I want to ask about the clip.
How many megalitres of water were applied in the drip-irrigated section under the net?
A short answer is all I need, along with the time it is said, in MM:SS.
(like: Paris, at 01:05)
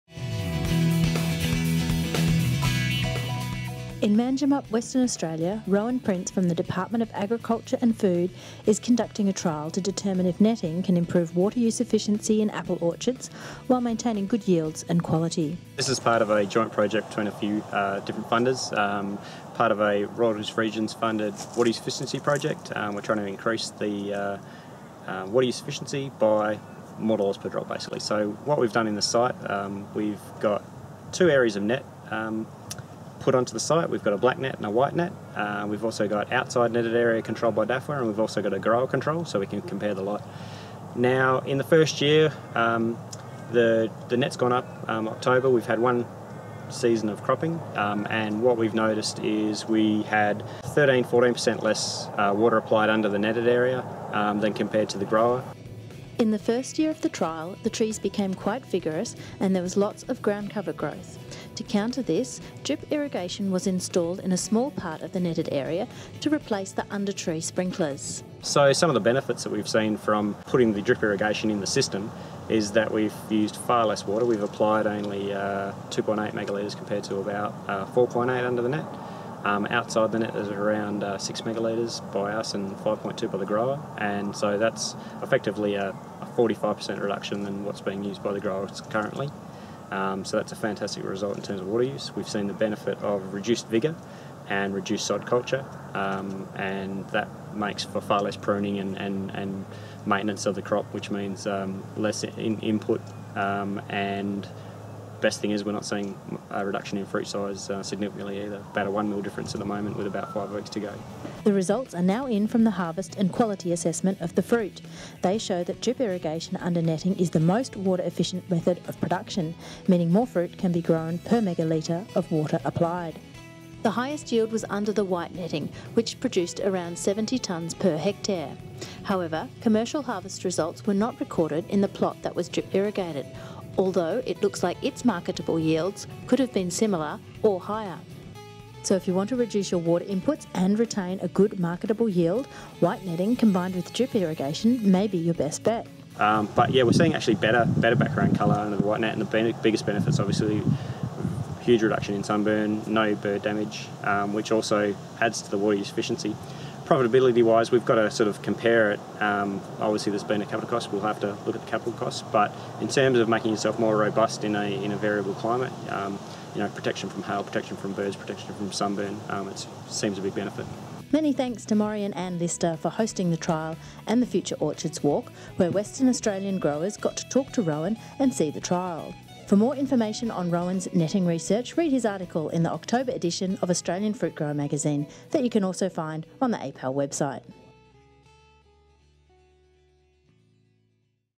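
2.8 megalitres, at 01:15.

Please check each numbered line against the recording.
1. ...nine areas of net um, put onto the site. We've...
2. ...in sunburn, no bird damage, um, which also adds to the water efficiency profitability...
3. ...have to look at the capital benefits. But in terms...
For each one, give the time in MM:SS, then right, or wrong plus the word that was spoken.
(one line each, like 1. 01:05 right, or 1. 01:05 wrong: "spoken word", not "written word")
1. 00:31 wrong: "two", not "nine"
2. 02:32 right
3. 02:41 wrong: "costs", not "benefits".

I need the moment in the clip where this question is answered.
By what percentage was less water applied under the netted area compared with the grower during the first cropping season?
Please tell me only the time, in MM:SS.
00:50.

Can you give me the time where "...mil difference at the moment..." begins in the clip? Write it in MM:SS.
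01:49.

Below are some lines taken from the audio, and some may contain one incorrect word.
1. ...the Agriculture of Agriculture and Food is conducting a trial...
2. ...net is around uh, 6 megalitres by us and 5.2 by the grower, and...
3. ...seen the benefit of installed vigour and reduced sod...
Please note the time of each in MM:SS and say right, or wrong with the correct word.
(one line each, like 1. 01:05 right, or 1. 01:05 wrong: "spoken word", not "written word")
1. 00:06 wrong: "Department", not "Agriculture"
2. 01:20 right
3. 01:32 wrong: "reduced", not "installed".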